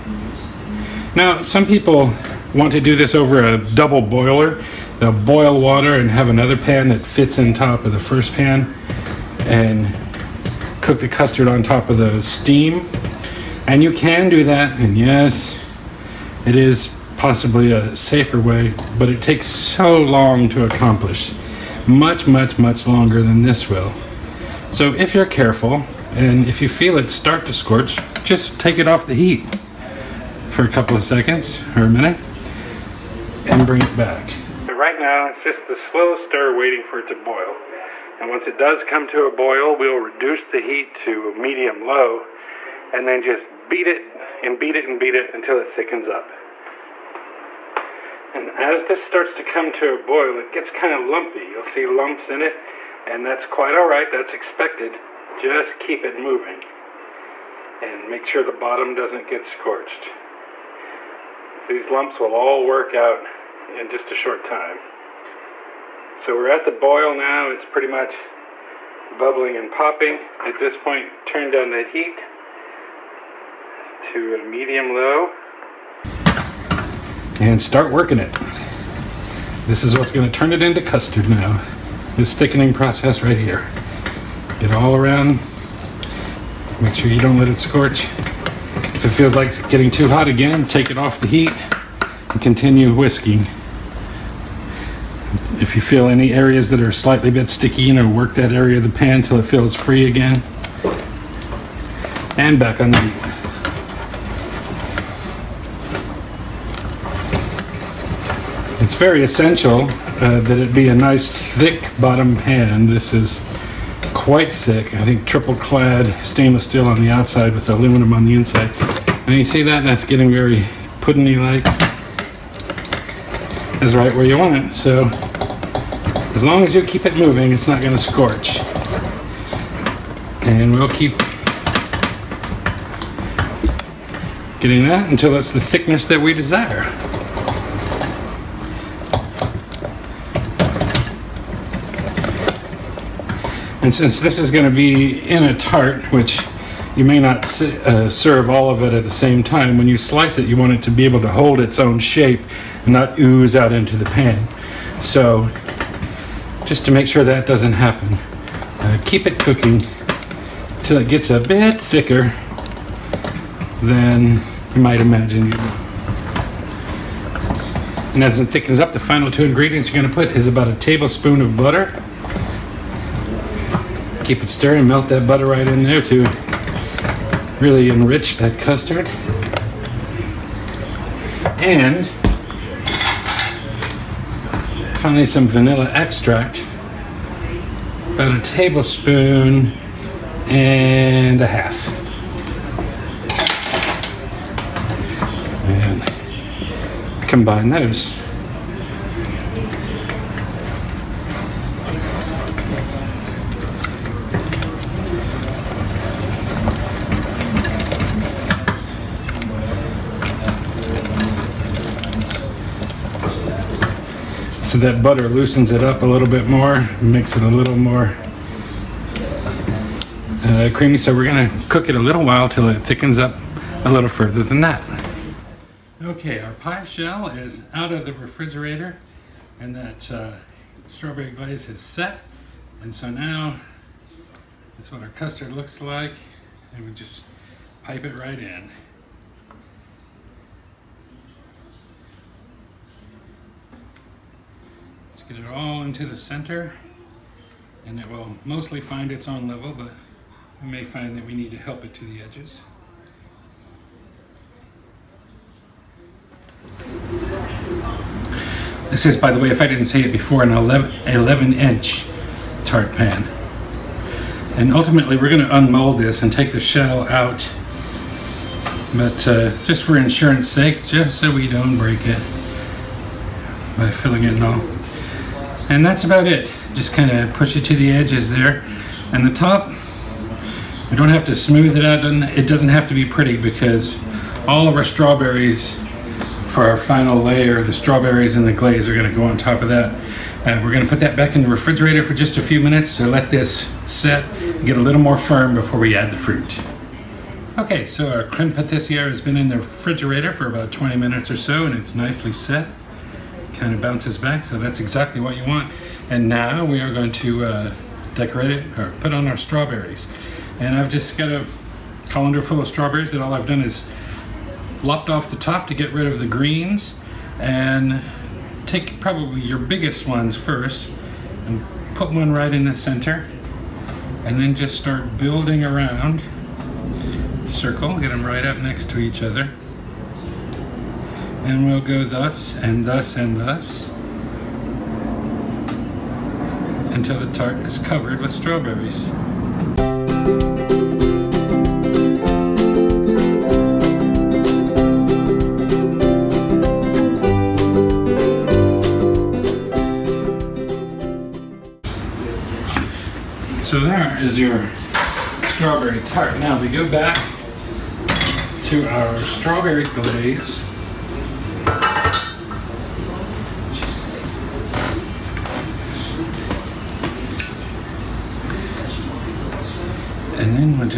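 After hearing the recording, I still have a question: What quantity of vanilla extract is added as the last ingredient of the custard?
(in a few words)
a tablespoon and a half.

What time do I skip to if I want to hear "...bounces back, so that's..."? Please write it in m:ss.
5:03.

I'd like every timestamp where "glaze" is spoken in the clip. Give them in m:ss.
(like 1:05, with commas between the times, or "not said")
3:51, 4:48, 5:59.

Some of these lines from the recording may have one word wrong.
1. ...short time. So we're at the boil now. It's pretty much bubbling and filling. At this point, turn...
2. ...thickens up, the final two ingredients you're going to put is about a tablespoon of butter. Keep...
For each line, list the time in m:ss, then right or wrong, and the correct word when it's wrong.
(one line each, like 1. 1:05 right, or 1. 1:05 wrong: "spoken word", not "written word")
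1. 1:04 wrong: "popping", not "filling"
2. 2:48 right.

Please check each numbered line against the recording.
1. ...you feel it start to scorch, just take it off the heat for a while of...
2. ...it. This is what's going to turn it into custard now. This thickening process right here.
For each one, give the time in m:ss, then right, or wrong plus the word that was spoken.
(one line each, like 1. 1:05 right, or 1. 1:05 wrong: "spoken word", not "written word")
1. 0:26 wrong: "couple", not "while"
2. 1:18 right.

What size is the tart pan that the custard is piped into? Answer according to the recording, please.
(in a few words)
11 inch.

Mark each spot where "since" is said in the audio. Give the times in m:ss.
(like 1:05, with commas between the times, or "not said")
2:23.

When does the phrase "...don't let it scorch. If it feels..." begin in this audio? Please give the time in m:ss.
1:27.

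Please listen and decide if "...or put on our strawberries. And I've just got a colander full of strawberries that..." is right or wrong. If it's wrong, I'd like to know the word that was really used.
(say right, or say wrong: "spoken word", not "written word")
right.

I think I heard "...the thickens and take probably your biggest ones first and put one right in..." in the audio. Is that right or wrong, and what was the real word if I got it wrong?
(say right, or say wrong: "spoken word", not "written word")
wrong: "greens", not "thickens".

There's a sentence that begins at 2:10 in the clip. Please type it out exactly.
And we'll keep getting that until it's the thickness that we desire.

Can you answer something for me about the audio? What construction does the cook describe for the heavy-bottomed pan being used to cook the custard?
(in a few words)
triple clad stainless steel.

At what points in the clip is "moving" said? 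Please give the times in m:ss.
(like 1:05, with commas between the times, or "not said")
0:56, 2:07.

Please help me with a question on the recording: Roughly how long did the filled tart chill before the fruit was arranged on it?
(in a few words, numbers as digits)
20 minutes.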